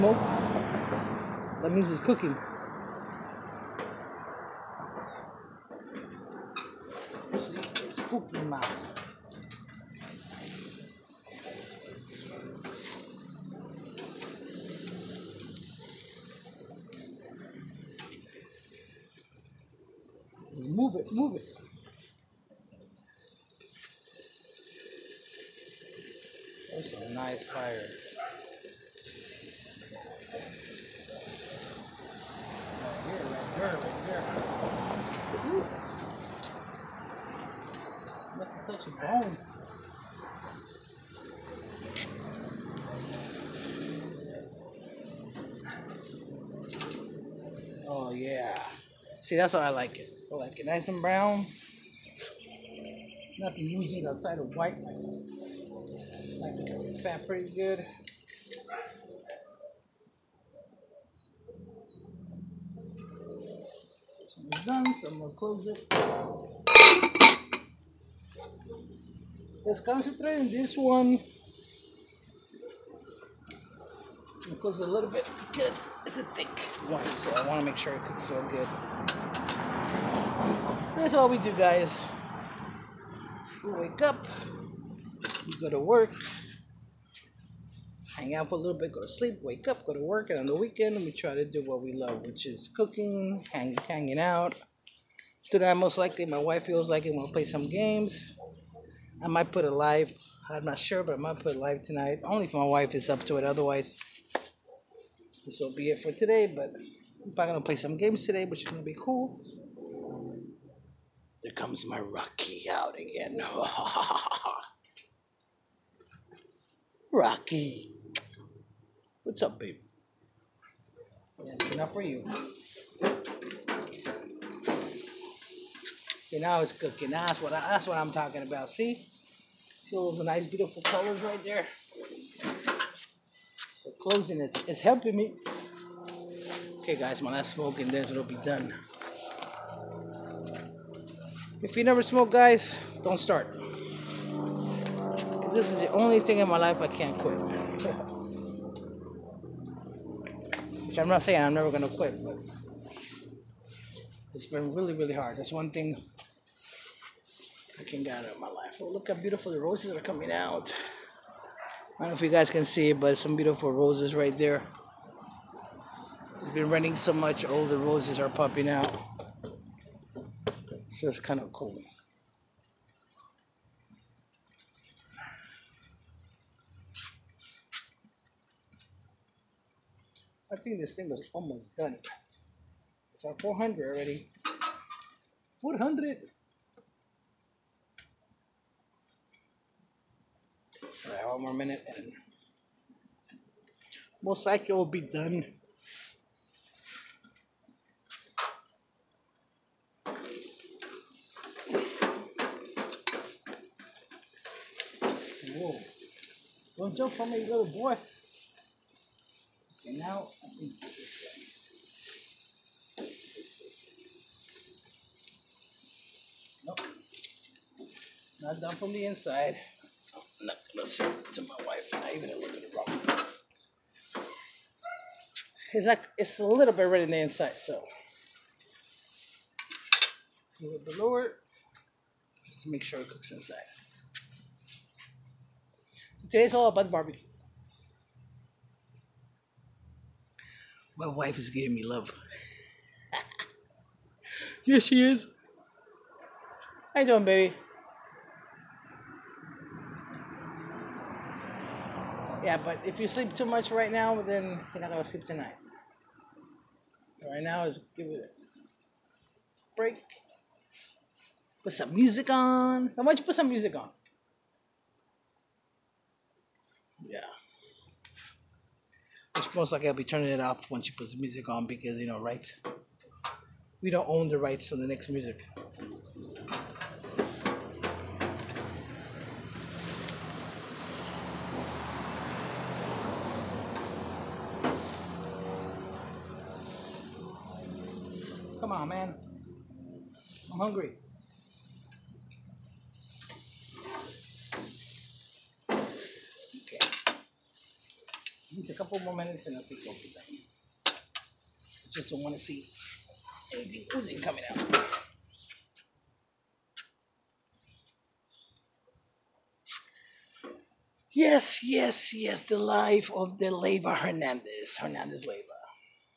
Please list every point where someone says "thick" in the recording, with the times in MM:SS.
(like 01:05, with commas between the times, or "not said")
01:16.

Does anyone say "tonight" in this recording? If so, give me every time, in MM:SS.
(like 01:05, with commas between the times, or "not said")
01:35, 01:41, 04:15.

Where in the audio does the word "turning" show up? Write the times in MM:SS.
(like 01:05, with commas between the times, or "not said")
04:30.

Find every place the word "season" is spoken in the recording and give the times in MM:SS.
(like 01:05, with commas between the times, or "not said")
not said.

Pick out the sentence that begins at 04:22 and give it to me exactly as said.
why don't you put some music on?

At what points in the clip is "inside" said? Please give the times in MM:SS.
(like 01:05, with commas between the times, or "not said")
03:39, 03:47, 03:53.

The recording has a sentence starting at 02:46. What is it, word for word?
It's been raining so much, all the roses are popping out just kind of cool.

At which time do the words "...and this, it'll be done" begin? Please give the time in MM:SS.
02:17.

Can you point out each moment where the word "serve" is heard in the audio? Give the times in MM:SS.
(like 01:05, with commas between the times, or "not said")
03:40.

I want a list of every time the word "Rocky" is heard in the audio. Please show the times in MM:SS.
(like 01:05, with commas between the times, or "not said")
01:51, 01:57.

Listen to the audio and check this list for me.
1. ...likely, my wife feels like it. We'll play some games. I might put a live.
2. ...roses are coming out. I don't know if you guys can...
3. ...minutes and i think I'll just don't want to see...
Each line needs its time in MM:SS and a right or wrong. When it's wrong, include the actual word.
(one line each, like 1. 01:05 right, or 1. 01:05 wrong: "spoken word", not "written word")
1. 01:35 right
2. 02:39 right
3. 04:59 right.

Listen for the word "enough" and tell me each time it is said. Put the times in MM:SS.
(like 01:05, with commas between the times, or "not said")
02:01.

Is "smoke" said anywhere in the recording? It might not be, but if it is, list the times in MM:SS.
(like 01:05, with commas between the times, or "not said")
02:17, 02:22.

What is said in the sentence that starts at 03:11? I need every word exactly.
Alright, one more minute and most likely it will be done.